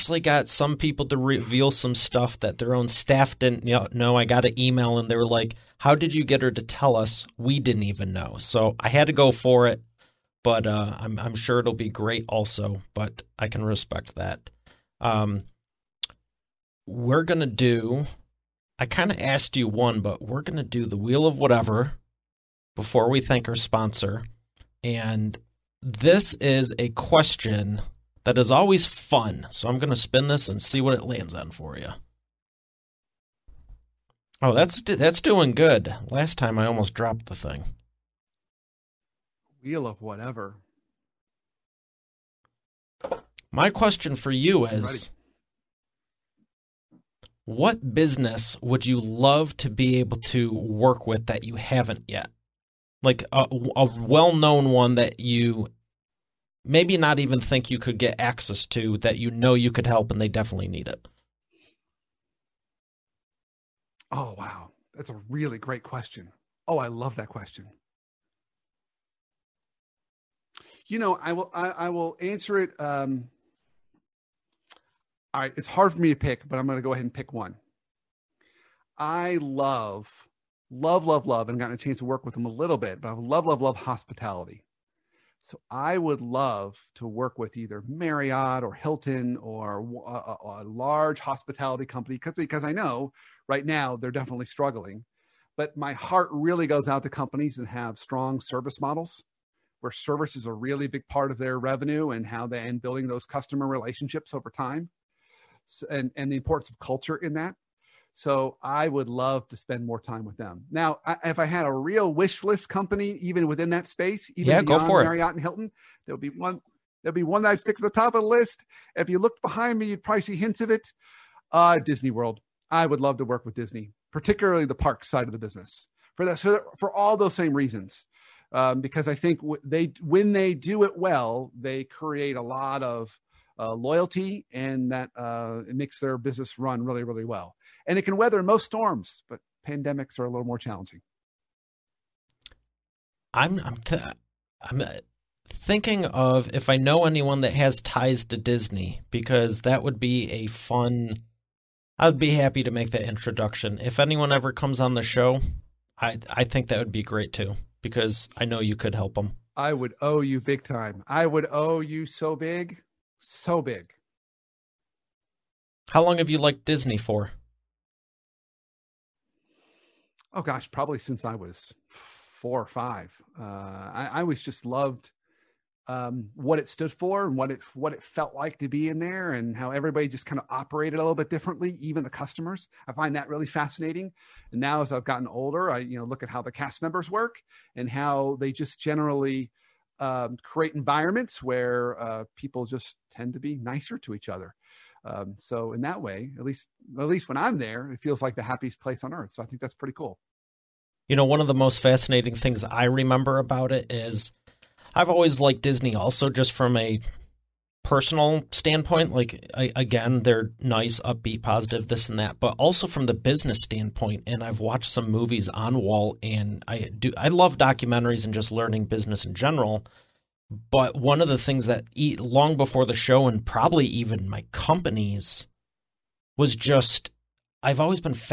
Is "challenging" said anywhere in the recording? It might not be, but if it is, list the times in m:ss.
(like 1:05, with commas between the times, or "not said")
2:20.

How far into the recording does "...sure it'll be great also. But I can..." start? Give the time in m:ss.
0:11.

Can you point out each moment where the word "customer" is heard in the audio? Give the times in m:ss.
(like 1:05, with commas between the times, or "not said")
1:43, 3:02.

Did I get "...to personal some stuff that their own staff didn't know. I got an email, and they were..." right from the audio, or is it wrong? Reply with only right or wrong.
wrong.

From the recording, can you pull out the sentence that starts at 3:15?
Um, so in that way, at least at least when I'm there, it feels like the happiest place on earth.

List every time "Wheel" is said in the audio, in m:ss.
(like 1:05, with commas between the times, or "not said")
0:20, 0:39.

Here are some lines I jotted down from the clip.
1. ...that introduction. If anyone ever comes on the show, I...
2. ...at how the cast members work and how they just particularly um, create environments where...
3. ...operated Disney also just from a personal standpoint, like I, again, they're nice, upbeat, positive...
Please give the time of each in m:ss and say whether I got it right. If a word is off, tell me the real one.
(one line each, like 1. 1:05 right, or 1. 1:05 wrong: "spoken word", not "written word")
1. 2:32 right
2. 3:06 wrong: "generally", not "particularly"
3. 3:25 wrong: "liked", not "operated".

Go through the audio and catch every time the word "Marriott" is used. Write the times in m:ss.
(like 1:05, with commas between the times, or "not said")
1:27, 1:54.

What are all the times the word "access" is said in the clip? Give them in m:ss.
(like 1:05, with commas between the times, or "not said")
0:58.